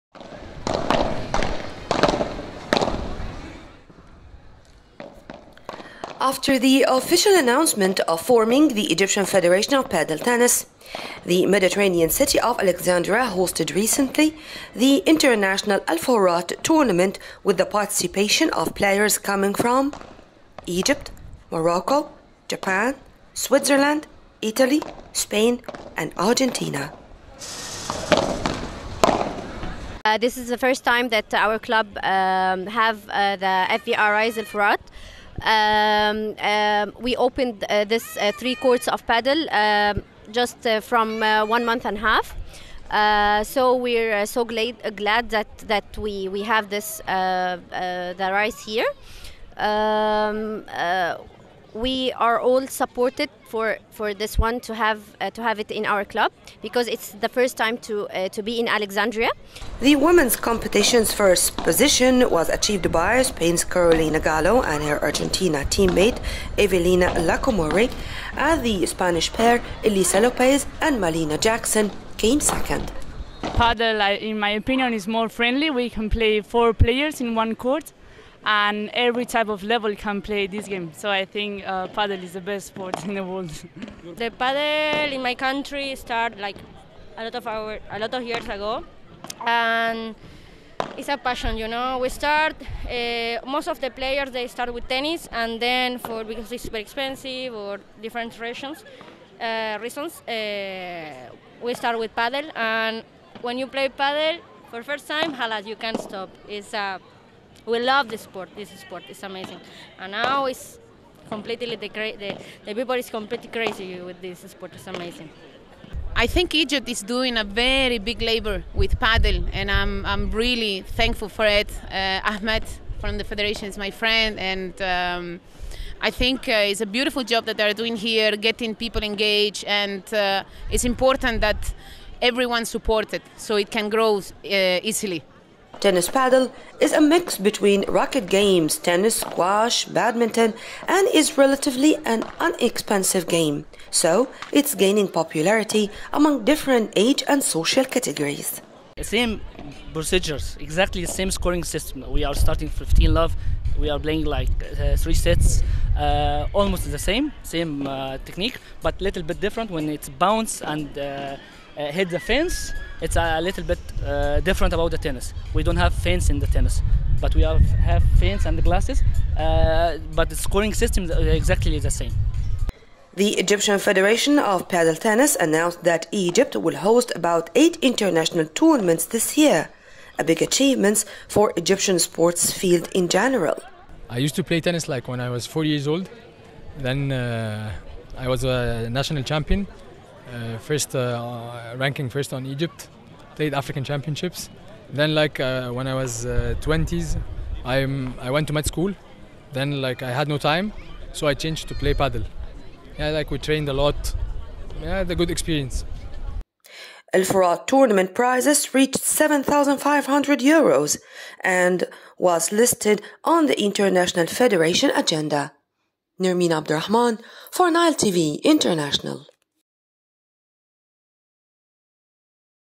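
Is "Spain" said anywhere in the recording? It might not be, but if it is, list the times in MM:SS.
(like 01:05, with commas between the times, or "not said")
00:25, 01:03.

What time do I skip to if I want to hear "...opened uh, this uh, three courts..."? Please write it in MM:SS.
00:37.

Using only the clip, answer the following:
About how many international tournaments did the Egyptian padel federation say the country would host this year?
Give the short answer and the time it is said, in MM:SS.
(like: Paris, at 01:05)
8, at 02:57.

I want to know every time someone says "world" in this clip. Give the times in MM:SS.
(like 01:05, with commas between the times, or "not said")
01:23.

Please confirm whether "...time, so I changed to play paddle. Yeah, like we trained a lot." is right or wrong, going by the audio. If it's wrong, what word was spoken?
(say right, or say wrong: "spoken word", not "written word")
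right.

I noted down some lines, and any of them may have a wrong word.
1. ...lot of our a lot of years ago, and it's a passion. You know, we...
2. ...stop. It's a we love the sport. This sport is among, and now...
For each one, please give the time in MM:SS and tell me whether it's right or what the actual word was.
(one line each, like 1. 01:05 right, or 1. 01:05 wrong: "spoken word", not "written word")
1. 01:27 right
2. 01:45 wrong: "amazing", not "among".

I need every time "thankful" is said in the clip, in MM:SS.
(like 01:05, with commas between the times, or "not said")
02:00.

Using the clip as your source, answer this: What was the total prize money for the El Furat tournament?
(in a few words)
7,500 euros.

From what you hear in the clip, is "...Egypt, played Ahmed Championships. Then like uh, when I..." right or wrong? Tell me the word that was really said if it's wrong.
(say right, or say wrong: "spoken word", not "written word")
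wrong: "African", not "Ahmed".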